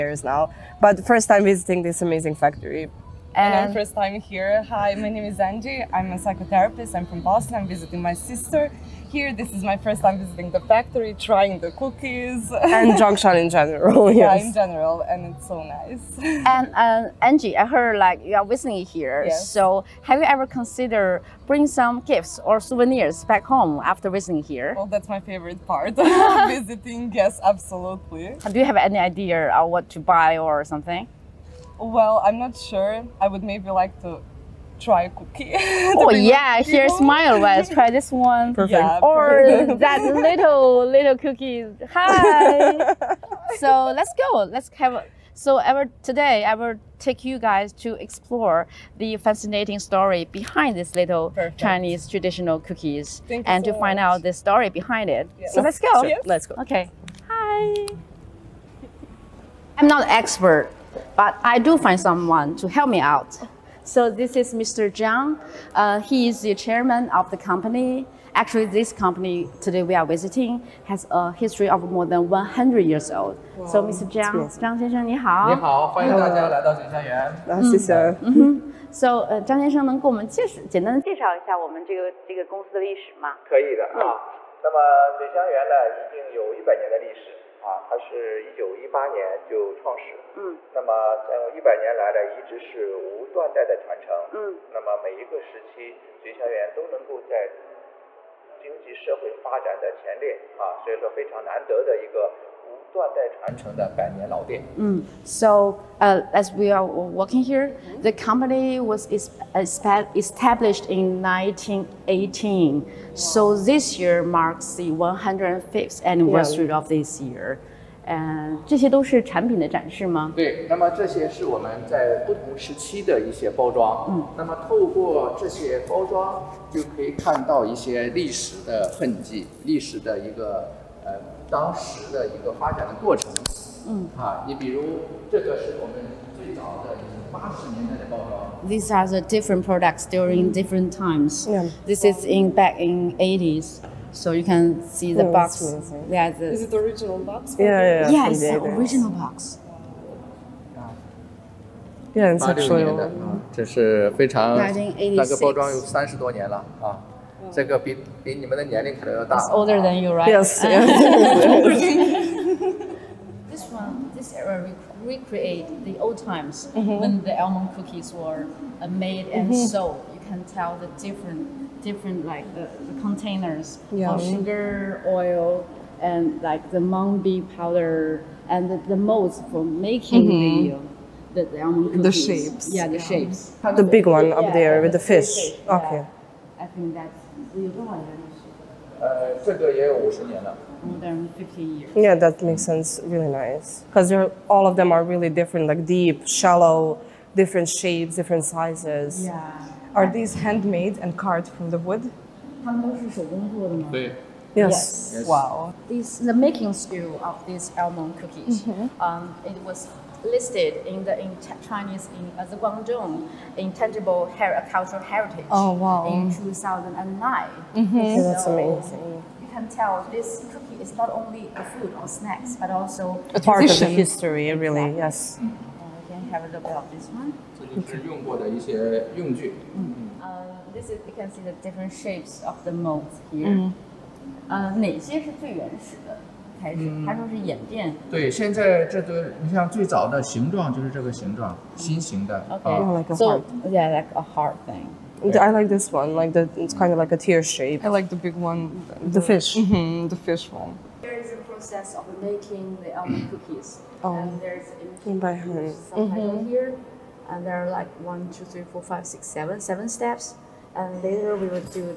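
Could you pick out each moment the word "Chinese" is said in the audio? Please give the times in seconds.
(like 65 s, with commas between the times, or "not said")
51 s, 211 s.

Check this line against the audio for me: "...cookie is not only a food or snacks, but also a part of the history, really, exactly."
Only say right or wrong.
right.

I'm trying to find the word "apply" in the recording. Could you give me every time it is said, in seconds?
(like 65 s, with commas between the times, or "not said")
not said.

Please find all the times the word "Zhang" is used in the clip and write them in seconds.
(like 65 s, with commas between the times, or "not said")
64 s, 74 s.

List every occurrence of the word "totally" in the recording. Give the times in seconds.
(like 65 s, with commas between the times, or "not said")
not said.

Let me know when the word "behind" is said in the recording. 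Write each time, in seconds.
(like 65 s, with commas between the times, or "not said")
50 s, 54 s.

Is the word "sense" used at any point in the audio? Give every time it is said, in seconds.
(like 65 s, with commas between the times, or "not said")
192 s.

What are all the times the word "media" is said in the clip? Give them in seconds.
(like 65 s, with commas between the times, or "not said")
not said.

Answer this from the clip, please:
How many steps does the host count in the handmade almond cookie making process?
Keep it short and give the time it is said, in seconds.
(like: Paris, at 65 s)
7, at 259 s.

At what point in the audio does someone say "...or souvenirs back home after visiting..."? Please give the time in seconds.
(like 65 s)
22 s.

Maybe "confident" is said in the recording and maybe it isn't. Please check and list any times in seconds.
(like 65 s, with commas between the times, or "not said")
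not said.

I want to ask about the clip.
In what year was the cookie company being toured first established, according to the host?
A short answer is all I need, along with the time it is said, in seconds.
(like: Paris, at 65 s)
1918, at 111 s.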